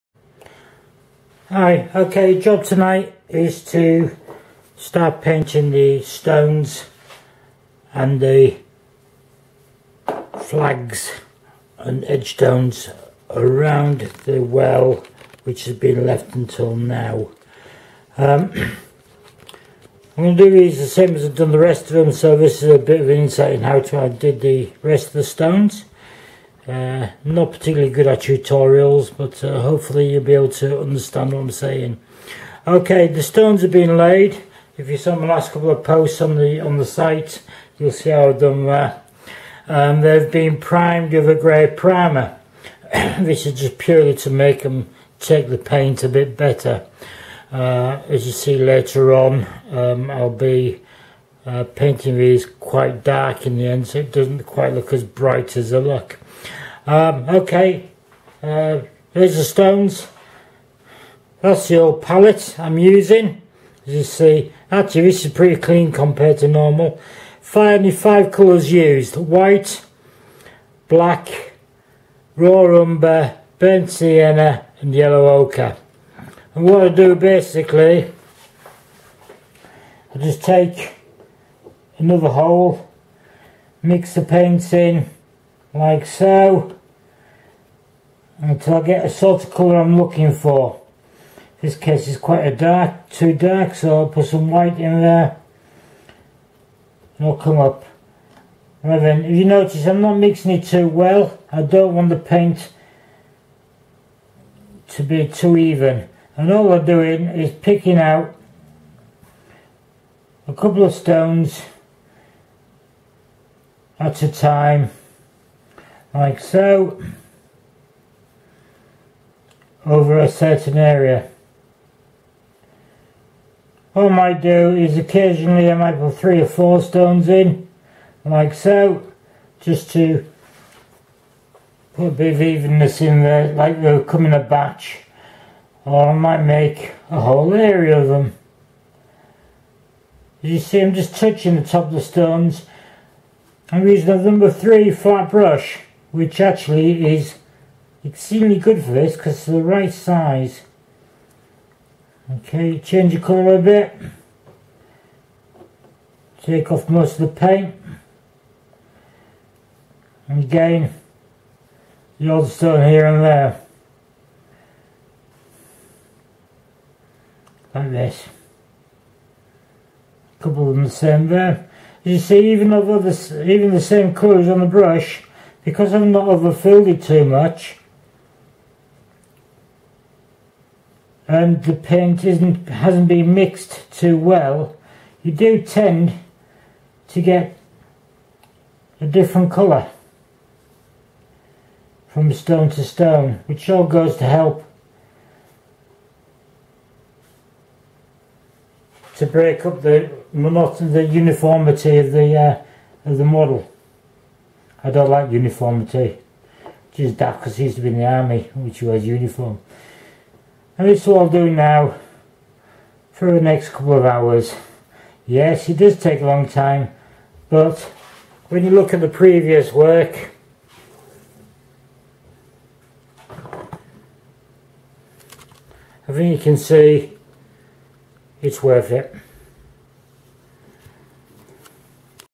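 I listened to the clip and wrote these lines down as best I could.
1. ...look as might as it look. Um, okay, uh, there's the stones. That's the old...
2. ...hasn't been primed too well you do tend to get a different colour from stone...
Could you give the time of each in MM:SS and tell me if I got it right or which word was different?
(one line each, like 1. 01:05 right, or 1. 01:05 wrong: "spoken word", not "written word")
1. 00:54 wrong: "bright", not "might"
2. 03:02 wrong: "mixed", not "primed".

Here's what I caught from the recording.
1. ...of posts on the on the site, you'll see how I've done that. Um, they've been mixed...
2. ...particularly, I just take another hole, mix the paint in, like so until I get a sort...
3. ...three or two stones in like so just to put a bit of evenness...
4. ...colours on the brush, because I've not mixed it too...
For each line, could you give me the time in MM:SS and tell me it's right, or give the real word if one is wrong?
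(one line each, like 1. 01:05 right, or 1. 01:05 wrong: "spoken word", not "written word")
1. 00:35 wrong: "primed", not "mixed"
2. 01:17 wrong: "basically", not "particularly"
3. 02:06 wrong: "four", not "two"
4. 02:54 wrong: "overfilled", not "mixed".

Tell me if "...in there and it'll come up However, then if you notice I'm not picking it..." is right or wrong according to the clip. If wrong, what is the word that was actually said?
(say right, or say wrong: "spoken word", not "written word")
wrong: "mixing", not "picking".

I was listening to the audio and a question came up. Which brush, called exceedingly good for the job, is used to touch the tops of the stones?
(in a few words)
Number 3 flat brush.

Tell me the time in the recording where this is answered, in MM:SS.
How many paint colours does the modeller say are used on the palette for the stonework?
01:07.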